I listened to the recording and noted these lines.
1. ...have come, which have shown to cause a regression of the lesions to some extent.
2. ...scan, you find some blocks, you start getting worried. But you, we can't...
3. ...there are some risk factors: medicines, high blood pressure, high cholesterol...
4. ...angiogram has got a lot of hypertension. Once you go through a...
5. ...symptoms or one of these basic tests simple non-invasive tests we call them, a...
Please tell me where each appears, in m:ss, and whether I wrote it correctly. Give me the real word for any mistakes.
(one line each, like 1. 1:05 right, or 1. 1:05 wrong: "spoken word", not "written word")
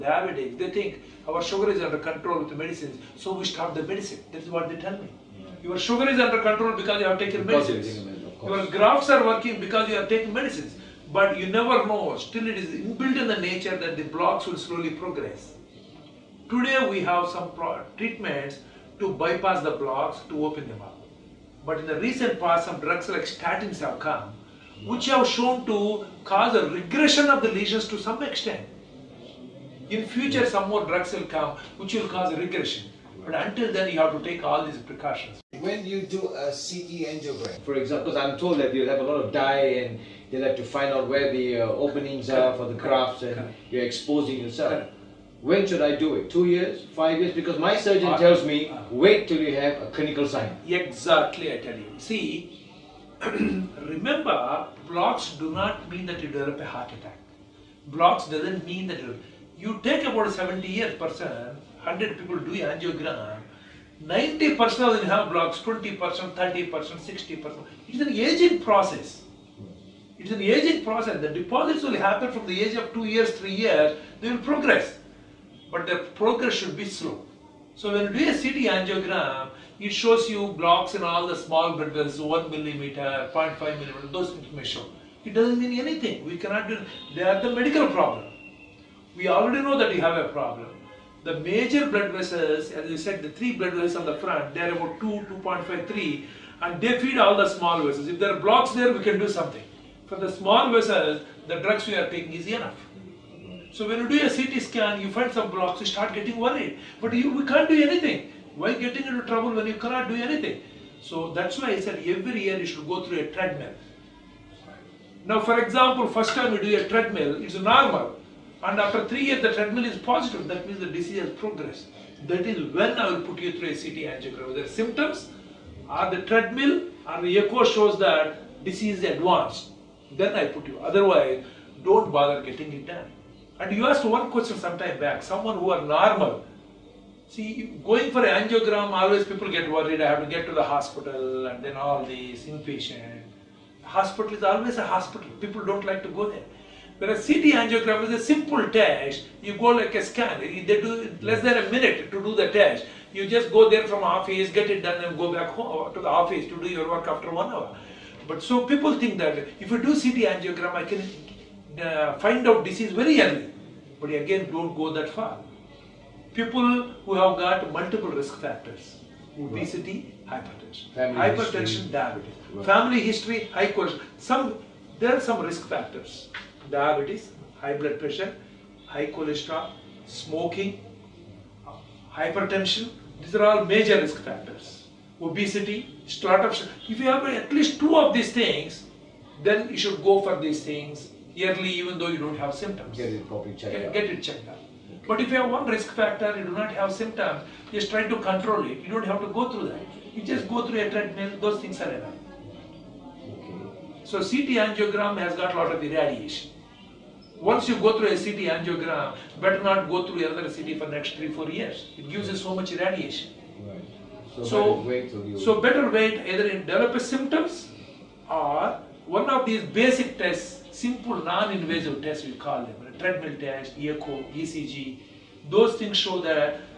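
1. 0:23 right
2. 1:44 right
3. 2:54 wrong: "diabetes", not "medicines"
4. 3:24 wrong: "irradiation", not "hypertension"
5. 3:37 right.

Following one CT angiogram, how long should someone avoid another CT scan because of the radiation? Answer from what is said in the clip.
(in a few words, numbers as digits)
3-4 years.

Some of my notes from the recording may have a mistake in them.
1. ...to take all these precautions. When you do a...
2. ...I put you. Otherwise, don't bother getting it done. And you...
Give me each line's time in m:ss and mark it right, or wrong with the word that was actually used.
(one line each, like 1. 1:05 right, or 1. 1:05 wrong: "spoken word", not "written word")
1. 0:34 right
2. 2:10 right.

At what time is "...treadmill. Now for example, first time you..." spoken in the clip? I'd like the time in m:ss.
1:53.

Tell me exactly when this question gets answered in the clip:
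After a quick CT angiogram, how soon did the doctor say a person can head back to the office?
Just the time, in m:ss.
2:37.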